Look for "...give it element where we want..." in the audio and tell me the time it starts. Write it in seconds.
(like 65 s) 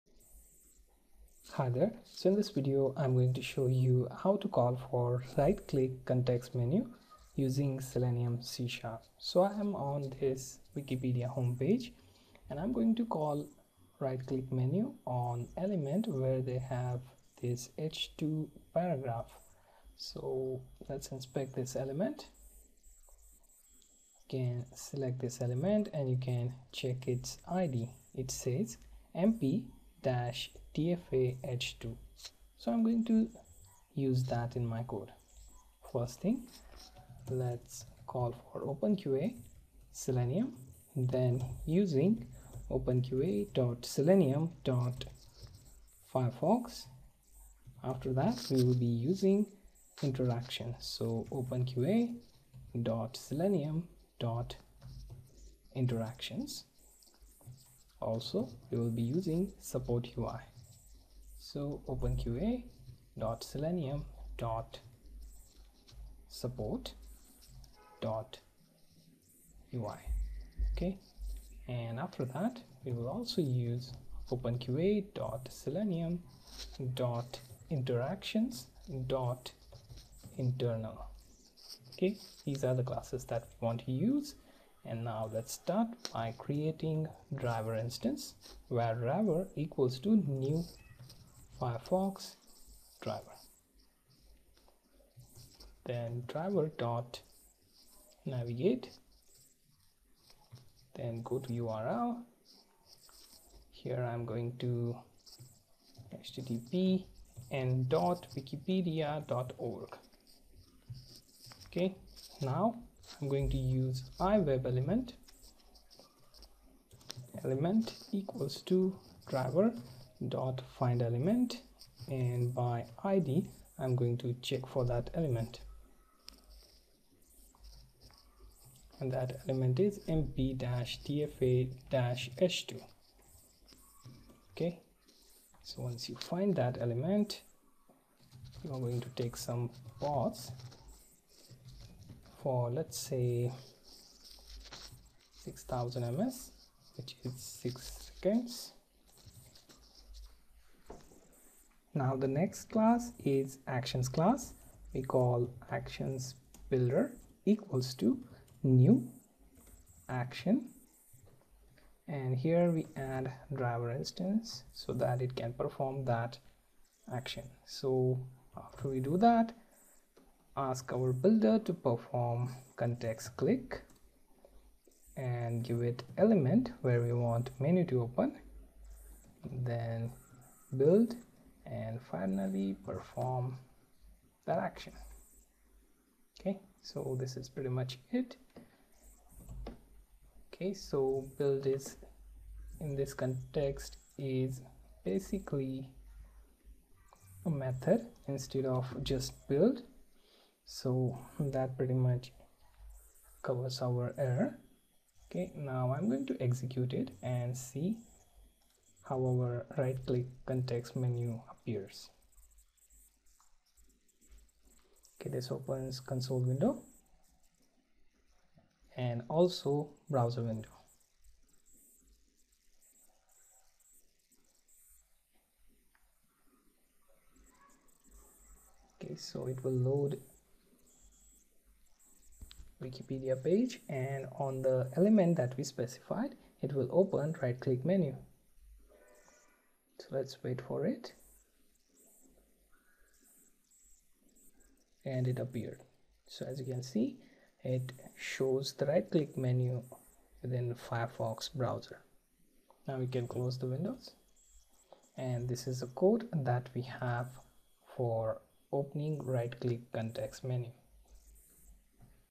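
175 s.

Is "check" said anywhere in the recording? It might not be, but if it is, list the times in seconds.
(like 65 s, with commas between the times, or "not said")
26 s, 124 s.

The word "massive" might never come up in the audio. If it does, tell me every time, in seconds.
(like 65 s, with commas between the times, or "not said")
not said.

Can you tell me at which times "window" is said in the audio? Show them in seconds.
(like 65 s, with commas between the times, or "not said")
216 s, 220 s, 253 s.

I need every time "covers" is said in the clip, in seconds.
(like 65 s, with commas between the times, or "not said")
203 s.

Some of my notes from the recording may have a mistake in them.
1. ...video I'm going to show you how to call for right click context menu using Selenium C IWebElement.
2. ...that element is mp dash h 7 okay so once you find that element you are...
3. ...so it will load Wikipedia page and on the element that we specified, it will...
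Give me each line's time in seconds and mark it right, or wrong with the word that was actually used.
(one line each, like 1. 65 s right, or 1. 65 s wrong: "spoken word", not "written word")
1. 2 s wrong: "Sharp", not "IWebElement"
2. 129 s wrong: "2", not "7"
3. 229 s right.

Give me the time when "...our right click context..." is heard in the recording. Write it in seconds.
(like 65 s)
209 s.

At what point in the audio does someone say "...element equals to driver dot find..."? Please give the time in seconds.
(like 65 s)
117 s.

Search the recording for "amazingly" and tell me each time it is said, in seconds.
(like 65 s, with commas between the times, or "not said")
not said.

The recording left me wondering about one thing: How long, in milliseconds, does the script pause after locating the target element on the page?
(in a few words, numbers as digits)
6000.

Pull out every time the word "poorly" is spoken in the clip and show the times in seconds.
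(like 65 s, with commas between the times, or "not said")
not said.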